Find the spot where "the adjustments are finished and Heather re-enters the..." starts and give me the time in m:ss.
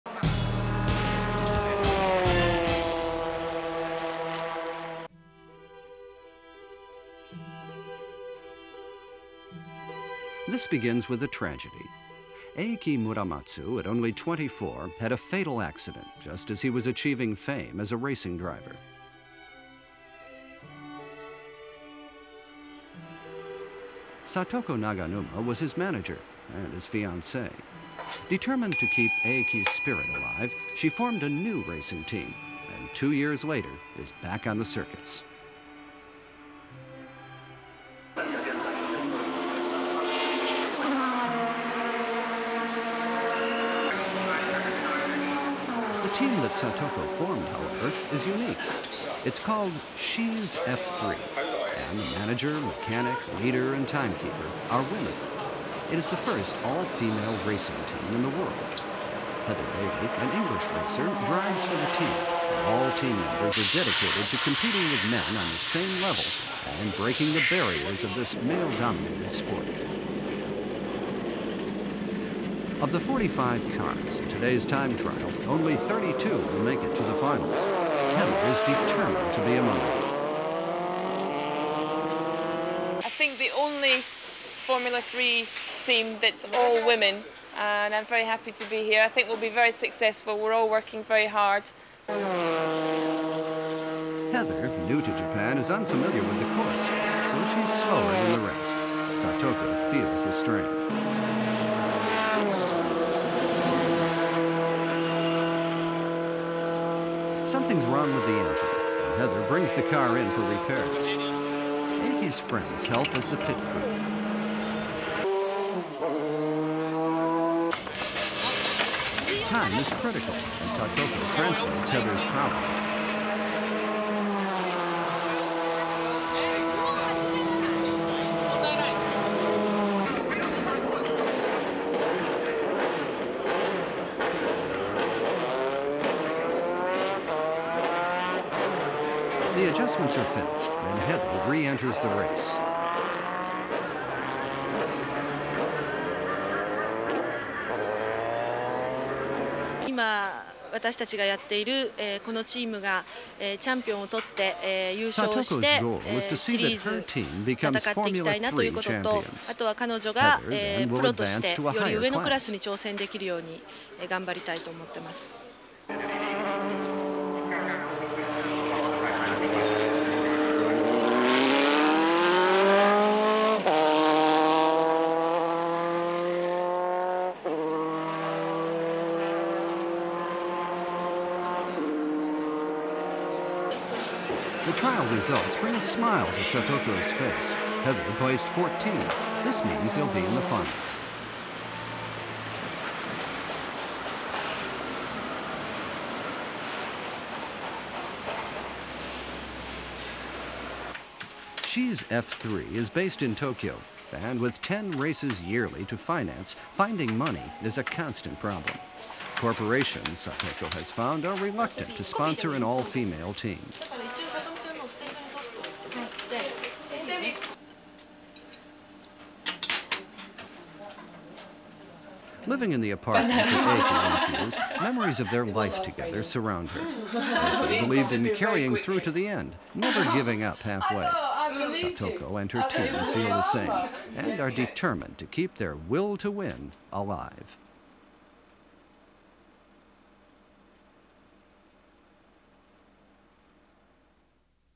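2:19.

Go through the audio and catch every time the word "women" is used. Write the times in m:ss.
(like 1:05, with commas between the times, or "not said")
0:54, 1:26.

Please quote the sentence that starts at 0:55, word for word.
It is the first all-female racing team in the world.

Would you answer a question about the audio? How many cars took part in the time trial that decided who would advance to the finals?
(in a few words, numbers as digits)
45.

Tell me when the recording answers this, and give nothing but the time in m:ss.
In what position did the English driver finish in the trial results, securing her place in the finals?
3:07.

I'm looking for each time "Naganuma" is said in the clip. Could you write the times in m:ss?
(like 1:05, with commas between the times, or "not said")
0:24.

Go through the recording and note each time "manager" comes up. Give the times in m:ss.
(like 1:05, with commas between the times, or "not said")
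0:25, 0:52.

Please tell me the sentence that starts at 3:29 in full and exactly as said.
Corporations, Satoko has found, are reluctant to sponsor an all-female team.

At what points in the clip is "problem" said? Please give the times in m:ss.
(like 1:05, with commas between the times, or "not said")
2:02, 3:28.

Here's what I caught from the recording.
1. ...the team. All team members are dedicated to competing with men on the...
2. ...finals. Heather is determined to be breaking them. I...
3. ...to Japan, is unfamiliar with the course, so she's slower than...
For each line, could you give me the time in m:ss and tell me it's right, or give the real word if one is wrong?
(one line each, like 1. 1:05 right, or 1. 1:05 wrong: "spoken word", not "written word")
1. 1:01 right
2. 1:17 wrong: "among", not "breaking"
3. 1:35 right.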